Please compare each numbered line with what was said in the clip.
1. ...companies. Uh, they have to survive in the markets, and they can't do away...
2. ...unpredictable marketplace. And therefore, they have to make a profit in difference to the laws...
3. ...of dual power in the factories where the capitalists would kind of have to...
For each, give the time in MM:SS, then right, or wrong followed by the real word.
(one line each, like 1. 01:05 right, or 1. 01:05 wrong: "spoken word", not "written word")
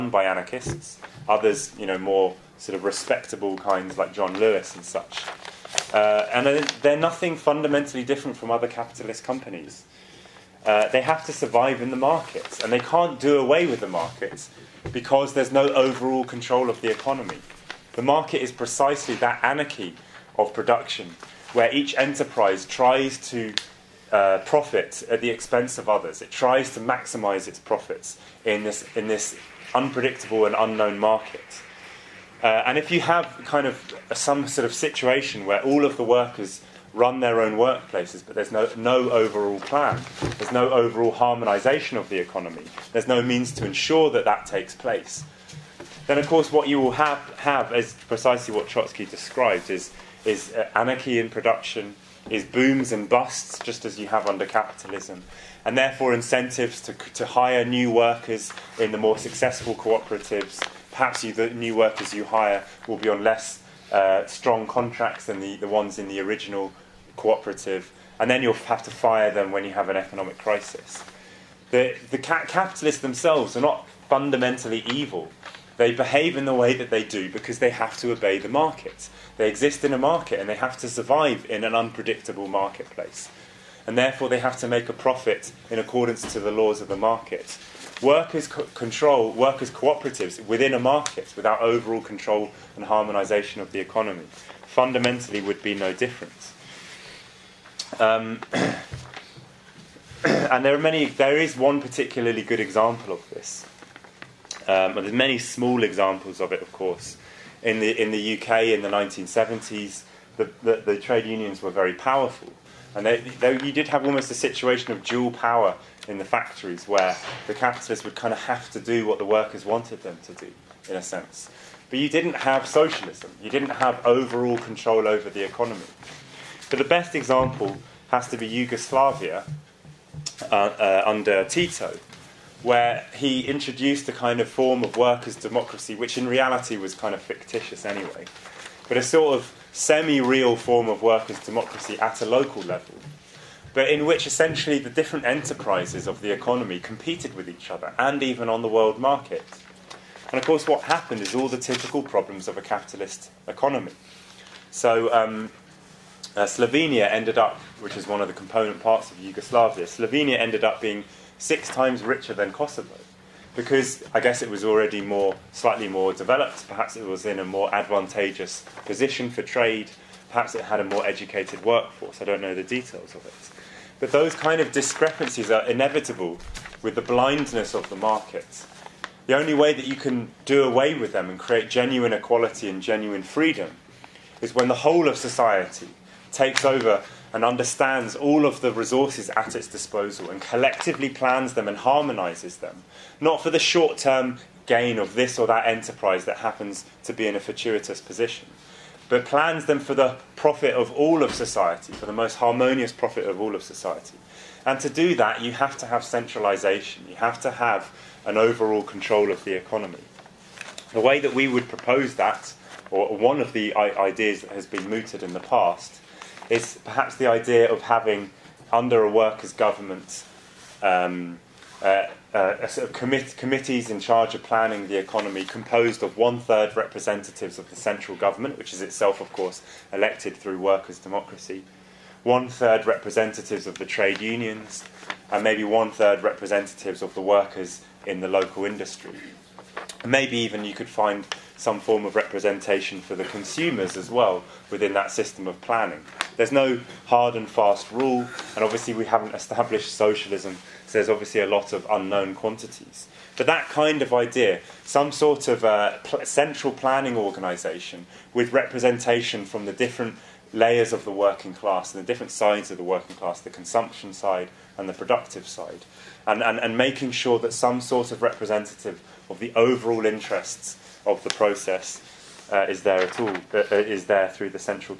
1. 00:09 right
2. 01:21 wrong: "accordance", not "difference"
3. 01:54 right.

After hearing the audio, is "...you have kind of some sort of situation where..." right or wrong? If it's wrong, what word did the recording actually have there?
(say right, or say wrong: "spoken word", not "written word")
right.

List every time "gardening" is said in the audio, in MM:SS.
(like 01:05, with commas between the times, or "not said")
not said.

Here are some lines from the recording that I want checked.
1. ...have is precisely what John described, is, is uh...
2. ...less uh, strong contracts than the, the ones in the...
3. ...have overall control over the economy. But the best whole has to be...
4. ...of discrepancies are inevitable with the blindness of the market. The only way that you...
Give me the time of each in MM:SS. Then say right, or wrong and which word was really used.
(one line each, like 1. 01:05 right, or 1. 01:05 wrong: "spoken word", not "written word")
1. 00:47 wrong: "Trotsky", not "John"
2. 01:03 right
3. 02:03 wrong: "example", not "whole"
4. 02:54 right.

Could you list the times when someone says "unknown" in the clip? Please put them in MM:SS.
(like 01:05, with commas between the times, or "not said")
00:30, 04:11.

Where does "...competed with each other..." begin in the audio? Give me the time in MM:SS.
02:26.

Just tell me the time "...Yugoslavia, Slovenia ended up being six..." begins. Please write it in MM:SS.
02:39.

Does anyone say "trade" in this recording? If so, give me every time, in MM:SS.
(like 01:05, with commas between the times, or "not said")
01:50, 02:49, 03:53.